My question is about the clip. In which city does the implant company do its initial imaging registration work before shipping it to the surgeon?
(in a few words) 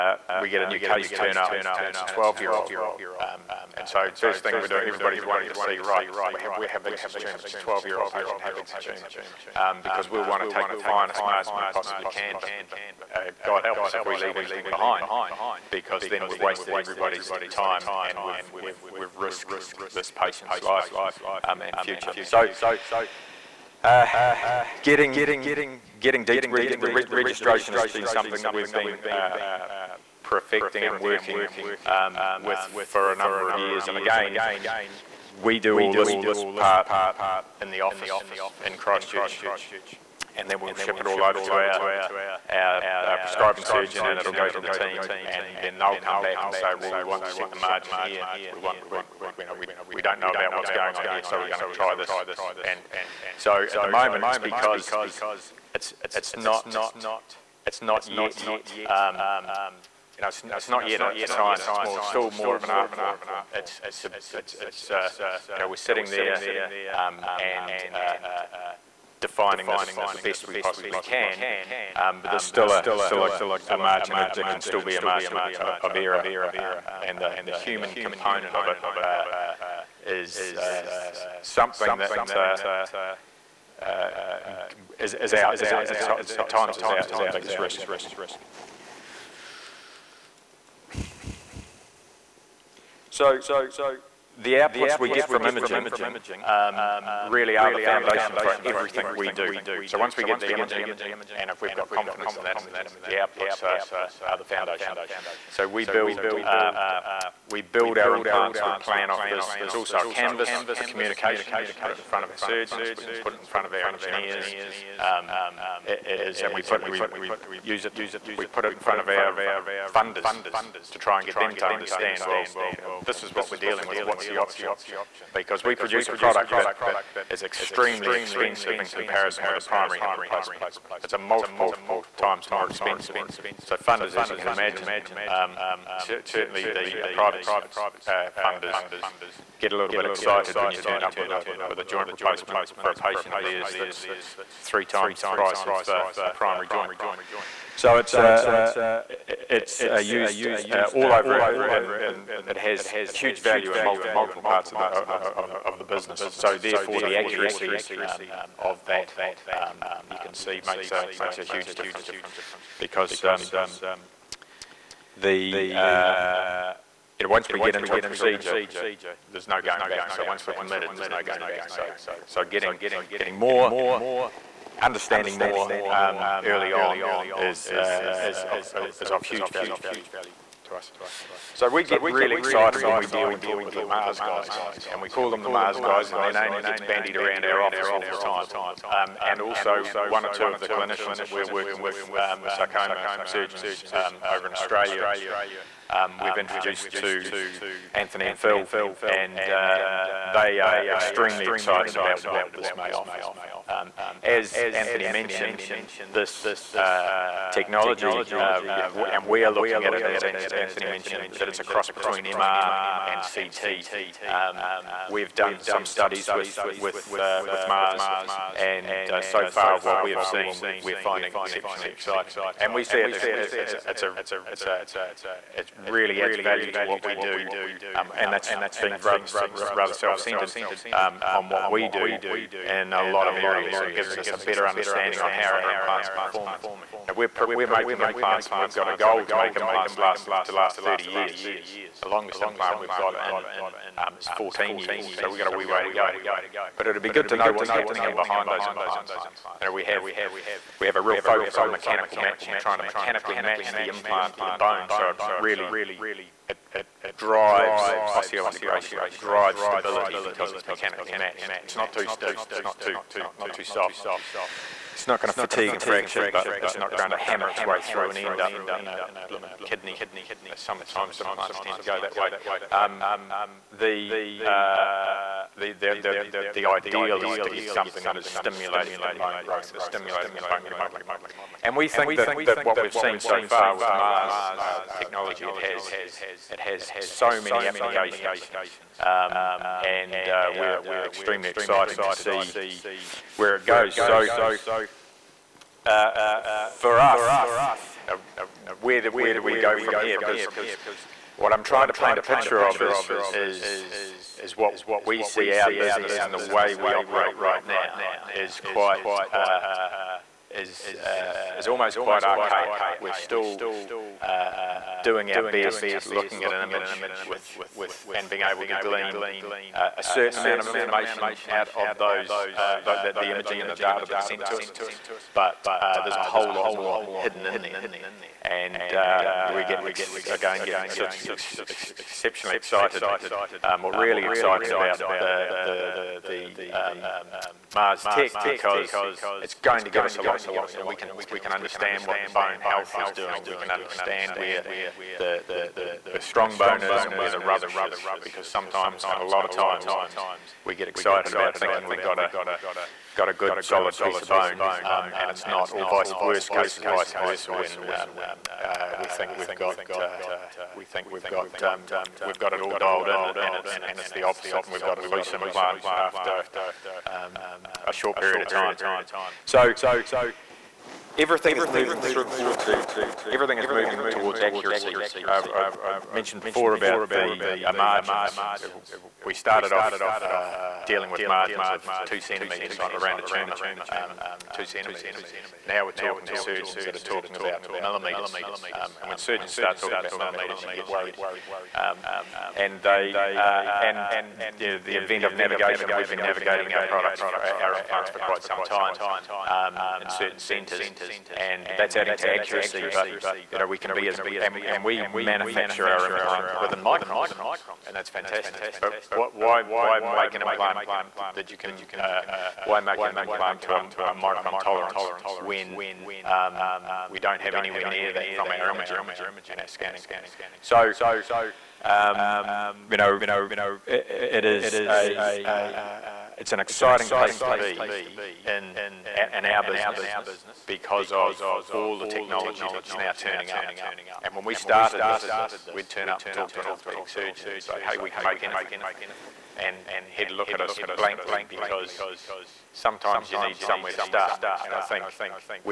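Christchurch.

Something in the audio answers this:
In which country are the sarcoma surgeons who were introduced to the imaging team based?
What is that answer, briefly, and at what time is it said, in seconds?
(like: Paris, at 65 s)
Australia, at 194 s.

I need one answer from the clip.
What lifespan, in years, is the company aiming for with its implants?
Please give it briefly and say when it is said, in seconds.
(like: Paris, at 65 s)
30 years, at 240 s.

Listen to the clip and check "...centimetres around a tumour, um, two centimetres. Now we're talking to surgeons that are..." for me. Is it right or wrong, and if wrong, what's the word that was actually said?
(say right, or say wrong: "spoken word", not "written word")
right.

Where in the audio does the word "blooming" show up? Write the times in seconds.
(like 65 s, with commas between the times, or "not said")
269 s.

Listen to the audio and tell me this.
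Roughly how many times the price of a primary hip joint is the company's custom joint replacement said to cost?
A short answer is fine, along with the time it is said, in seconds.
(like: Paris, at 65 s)
3 times, at 144 s.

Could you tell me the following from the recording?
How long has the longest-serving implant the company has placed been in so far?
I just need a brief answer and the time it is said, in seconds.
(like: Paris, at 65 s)
14 years, at 244 s.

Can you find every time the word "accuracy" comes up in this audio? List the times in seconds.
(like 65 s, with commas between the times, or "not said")
157 s, 374 s, 402 s.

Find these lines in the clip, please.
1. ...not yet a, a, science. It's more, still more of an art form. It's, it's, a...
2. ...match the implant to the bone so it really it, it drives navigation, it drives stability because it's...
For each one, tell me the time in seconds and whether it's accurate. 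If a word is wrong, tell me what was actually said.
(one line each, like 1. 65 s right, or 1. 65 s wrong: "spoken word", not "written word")
1. 60 s right
2. 253 s wrong: "osseointegration", not "navigation".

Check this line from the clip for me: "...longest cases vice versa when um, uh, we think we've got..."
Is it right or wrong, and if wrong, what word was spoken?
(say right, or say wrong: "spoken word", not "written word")
wrong: "worst", not "longest".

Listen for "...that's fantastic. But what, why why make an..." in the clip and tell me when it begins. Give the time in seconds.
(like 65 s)
407 s.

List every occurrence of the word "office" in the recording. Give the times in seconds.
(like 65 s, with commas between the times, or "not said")
37 s, 187 s.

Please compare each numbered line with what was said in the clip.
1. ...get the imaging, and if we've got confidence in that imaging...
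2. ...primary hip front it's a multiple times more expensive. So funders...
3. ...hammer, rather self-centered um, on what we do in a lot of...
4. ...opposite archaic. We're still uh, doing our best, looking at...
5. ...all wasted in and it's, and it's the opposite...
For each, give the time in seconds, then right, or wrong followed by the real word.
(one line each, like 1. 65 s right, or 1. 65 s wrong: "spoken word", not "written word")
1. 100 s right
2. 129 s wrong: "replacement", not "front"
3. 228 s wrong: "rather", not "hammer"
4. 311 s wrong: "quite", not "opposite"
5. 362 s wrong: "dialed", not "wasted".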